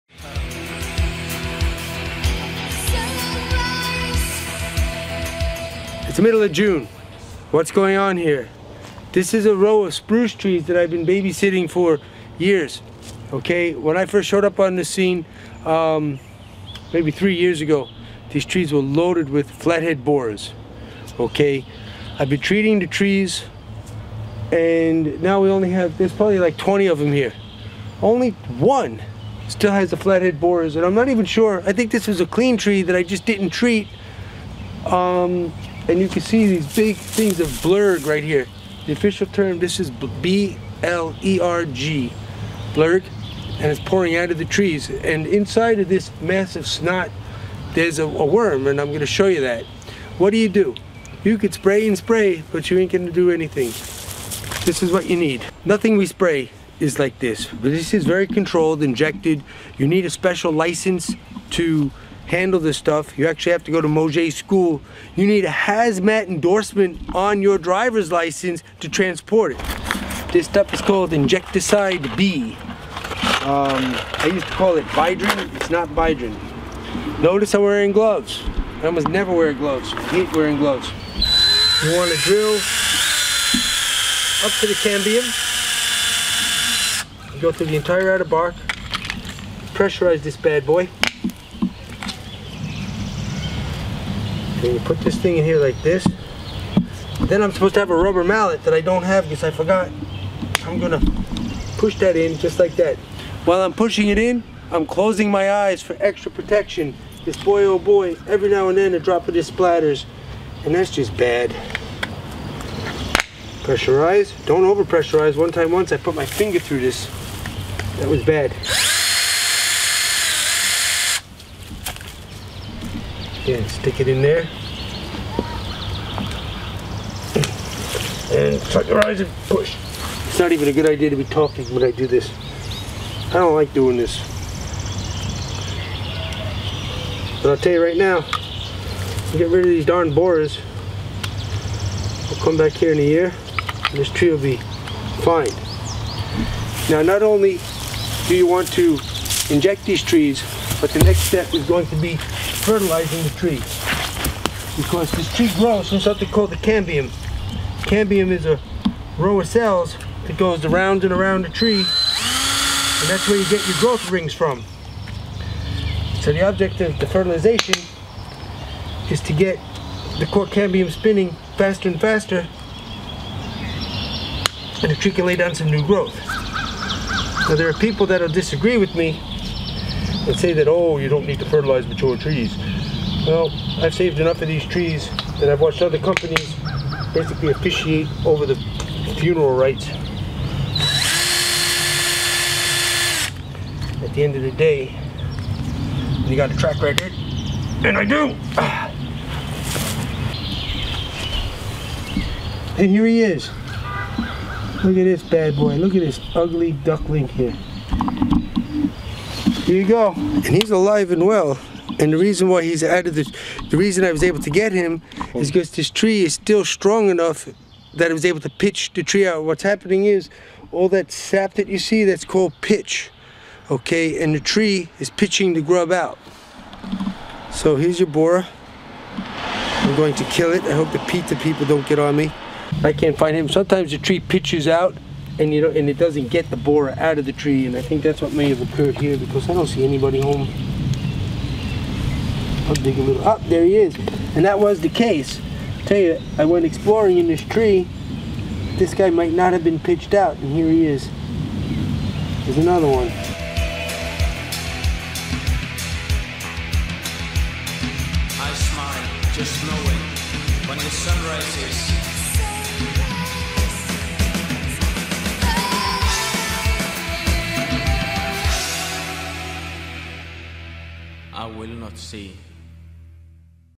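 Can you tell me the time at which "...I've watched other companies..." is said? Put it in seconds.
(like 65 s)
185 s.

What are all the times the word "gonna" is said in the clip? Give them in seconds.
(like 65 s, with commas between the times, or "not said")
48 s, 52 s, 100 s.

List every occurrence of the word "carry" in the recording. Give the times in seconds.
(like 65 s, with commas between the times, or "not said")
not said.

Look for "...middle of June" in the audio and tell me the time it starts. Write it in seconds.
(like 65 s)
6 s.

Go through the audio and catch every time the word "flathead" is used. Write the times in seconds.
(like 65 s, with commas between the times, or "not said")
19 s, 29 s.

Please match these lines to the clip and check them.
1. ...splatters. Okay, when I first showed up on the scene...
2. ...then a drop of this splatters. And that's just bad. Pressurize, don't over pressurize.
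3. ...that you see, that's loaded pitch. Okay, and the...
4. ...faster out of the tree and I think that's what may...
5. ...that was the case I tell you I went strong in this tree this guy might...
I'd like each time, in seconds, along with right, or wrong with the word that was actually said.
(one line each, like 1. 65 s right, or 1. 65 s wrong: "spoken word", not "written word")
1. 12 s wrong: "years", not "splatters"
2. 108 s right
3. 221 s wrong: "called", not "loaded"
4. 236 s wrong: "borer", not "faster"
5. 244 s wrong: "exploring", not "strong".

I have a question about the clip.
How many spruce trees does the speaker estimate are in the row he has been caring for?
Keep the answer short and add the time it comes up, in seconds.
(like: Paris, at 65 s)
20, at 26 s.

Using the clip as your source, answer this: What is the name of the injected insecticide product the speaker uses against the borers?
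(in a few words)
Inject-A-Cide B.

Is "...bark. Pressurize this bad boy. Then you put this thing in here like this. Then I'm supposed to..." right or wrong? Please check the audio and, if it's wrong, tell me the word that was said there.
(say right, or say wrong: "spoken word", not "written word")
right.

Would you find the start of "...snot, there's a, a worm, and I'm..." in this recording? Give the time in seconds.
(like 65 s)
46 s.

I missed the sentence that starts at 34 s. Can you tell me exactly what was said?
Um, and you can see these big things of blurg right here.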